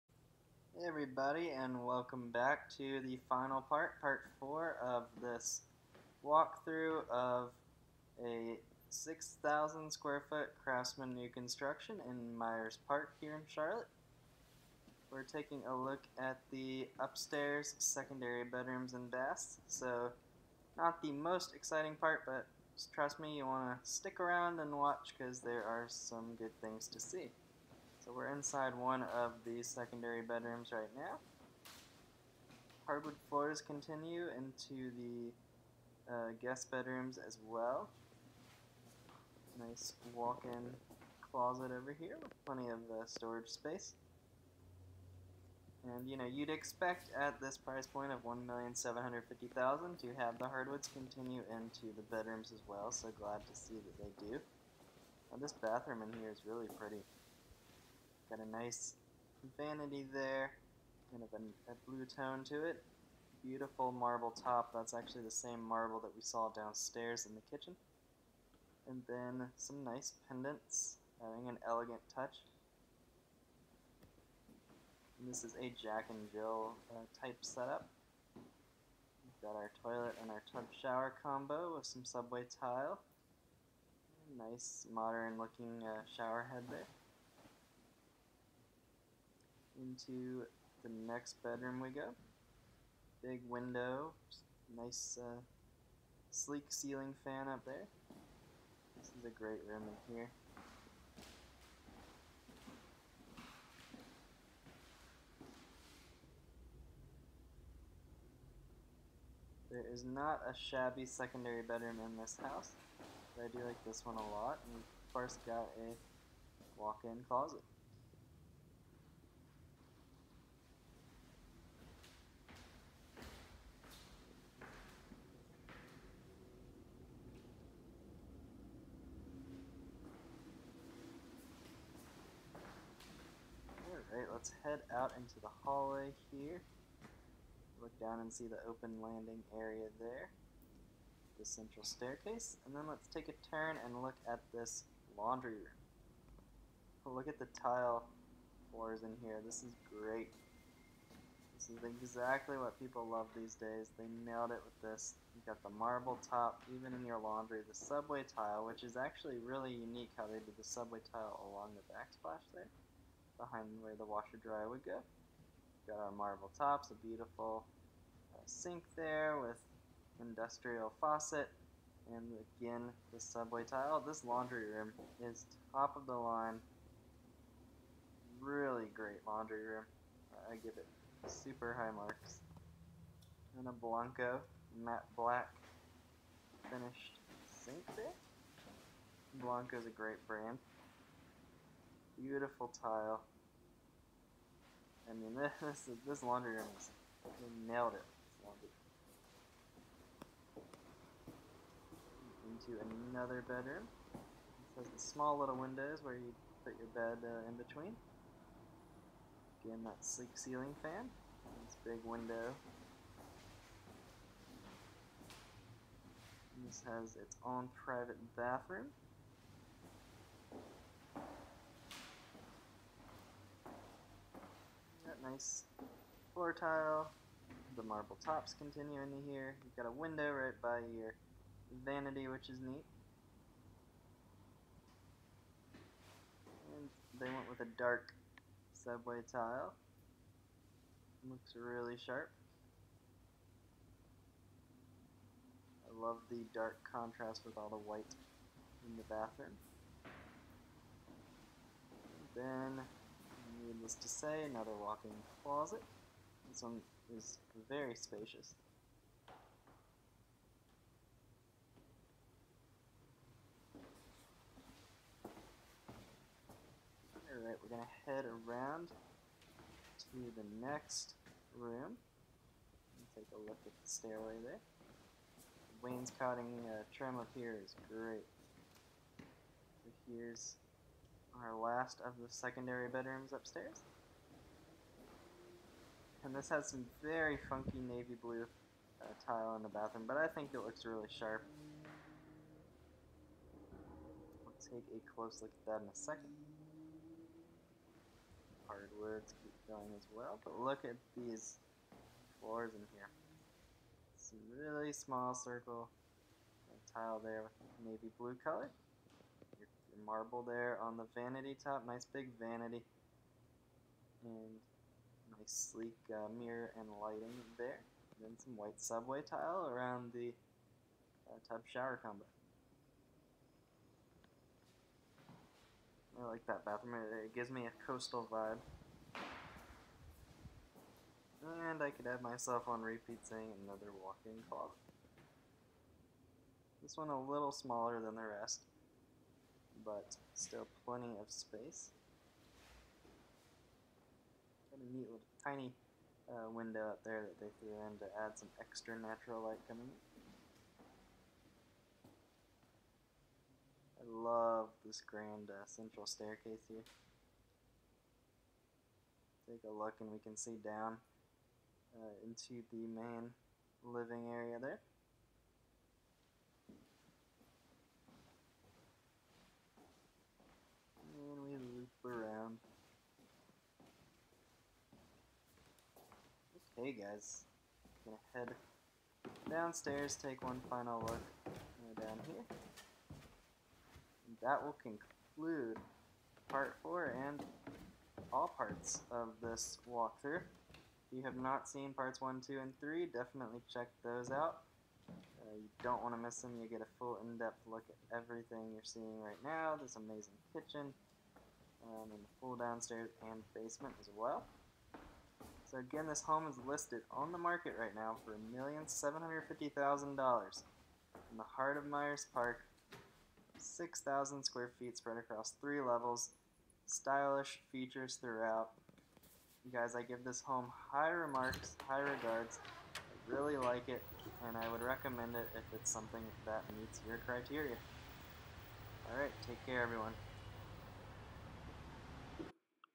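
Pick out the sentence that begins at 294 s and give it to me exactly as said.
We'll take a close look at that in a second.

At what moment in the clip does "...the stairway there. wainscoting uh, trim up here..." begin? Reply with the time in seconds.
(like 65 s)
273 s.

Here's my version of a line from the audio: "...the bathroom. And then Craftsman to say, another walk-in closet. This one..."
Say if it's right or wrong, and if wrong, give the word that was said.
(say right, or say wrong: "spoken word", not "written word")
wrong: "Needless", not "Craftsman".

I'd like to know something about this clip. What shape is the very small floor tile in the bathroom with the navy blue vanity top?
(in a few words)
Circle.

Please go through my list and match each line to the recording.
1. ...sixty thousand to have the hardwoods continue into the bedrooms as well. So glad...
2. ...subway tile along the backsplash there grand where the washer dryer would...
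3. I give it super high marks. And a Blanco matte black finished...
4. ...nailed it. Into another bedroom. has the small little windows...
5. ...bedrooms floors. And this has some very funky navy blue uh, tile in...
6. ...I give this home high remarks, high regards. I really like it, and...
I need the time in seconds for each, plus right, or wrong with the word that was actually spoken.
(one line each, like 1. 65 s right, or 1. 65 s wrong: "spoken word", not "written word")
1. 49 s wrong: "fifty", not "sixty"
2. 160 s wrong: "behind", not "grand"
3. 180 s right
4. 197 s right
5. 282 s wrong: "upstairs", not "floors"
6. 419 s right.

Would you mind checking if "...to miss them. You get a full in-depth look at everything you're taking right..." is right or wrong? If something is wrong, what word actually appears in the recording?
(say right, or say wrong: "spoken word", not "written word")
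wrong: "seeing", not "taking".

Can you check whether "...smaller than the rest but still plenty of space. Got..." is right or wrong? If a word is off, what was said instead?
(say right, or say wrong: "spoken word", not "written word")
right.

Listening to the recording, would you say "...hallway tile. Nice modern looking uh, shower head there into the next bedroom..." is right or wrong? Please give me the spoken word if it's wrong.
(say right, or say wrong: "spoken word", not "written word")
wrong: "subway", not "hallway".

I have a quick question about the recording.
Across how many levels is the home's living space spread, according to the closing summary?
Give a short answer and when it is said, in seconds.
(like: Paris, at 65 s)
3, at 415 s.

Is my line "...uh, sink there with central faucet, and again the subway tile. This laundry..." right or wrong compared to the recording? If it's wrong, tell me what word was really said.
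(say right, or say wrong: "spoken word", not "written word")
wrong: "industrial", not "central".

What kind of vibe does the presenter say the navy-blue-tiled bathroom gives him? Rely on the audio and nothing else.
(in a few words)
Coastal.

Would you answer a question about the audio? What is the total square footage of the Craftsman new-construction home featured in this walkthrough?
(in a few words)
6,000 square feet.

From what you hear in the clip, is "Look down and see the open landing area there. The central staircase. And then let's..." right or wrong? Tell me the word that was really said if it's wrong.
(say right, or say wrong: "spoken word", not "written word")
right.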